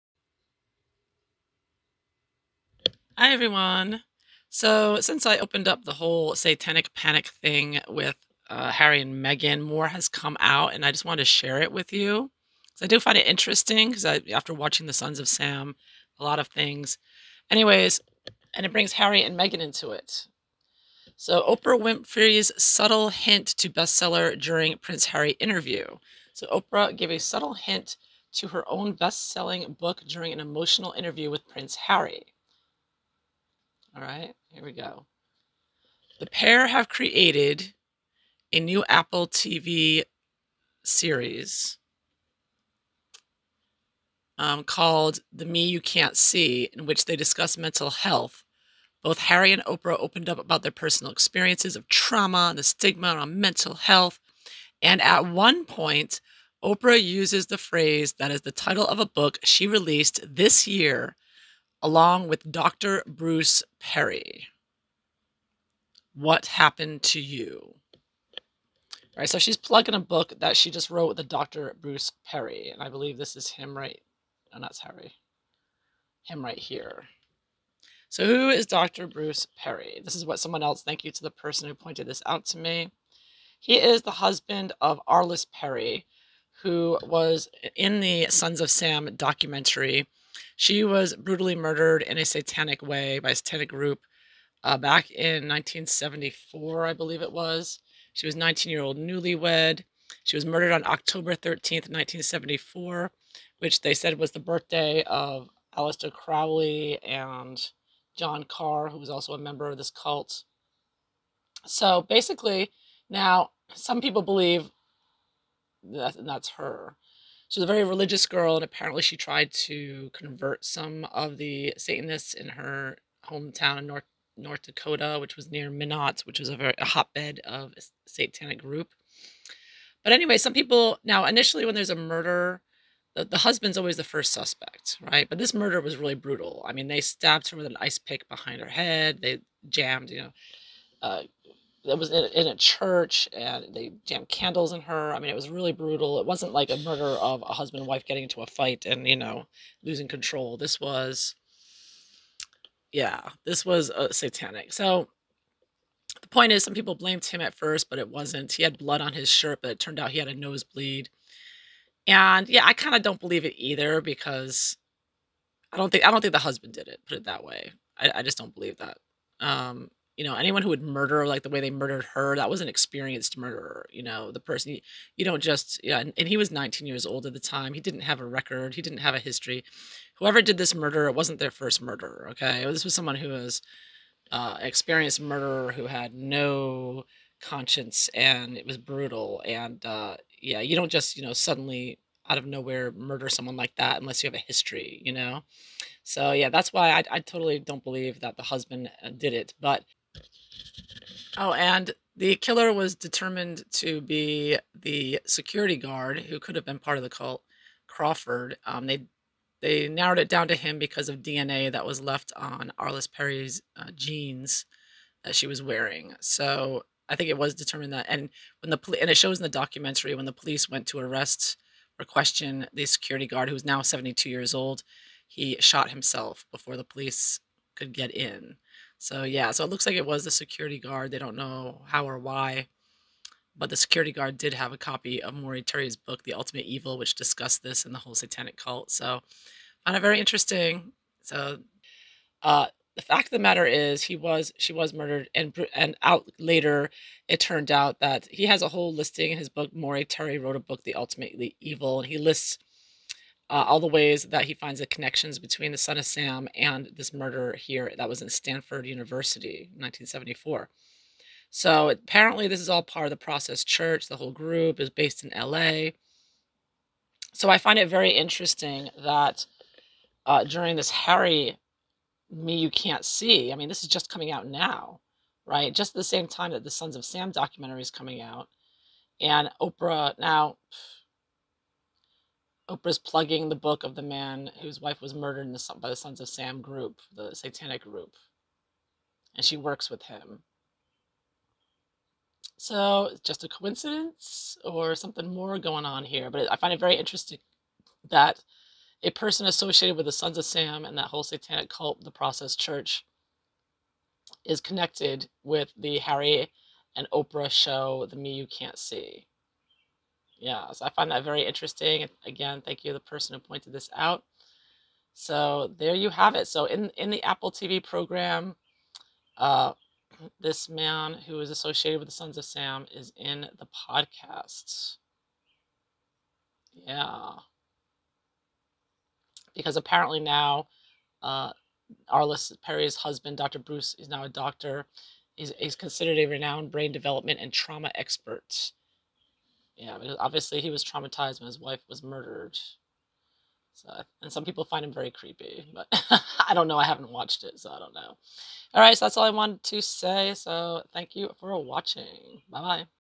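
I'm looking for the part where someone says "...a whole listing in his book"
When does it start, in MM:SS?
04:08.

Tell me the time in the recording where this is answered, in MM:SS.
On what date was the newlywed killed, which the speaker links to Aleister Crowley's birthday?
01:40.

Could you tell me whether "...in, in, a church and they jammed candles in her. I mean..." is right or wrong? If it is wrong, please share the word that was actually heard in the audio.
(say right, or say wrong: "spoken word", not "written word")
right.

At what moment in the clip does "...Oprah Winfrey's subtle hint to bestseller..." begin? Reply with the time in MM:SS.
00:21.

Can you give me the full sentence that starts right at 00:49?
Both Harry and Oprah opened up about their personal experiences of trauma and the stigma around mental health.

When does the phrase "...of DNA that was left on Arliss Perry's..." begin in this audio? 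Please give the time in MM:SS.
03:31.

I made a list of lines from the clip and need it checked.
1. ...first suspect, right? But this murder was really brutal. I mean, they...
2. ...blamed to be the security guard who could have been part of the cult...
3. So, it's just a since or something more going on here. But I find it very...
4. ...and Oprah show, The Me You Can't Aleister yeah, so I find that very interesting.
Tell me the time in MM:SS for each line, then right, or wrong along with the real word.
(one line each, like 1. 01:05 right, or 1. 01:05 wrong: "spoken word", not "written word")
1. 02:14 right
2. 03:22 wrong: "determined", not "blamed"
3. 04:52 wrong: "coincidence", not "since"
4. 05:06 wrong: "See", not "Aleister".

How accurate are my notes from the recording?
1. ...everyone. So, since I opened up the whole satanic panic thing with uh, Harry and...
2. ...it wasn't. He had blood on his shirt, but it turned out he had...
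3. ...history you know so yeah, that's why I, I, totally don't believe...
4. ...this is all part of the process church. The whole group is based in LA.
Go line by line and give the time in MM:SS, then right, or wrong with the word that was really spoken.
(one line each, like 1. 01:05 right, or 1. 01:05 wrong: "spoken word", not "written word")
1. 00:03 right
2. 02:37 right
3. 03:14 right
4. 04:22 right.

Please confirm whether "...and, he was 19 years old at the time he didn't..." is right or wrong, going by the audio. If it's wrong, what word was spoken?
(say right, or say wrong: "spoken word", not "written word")
right.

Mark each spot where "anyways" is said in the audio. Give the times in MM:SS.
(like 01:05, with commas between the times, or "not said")
00:17, 02:10.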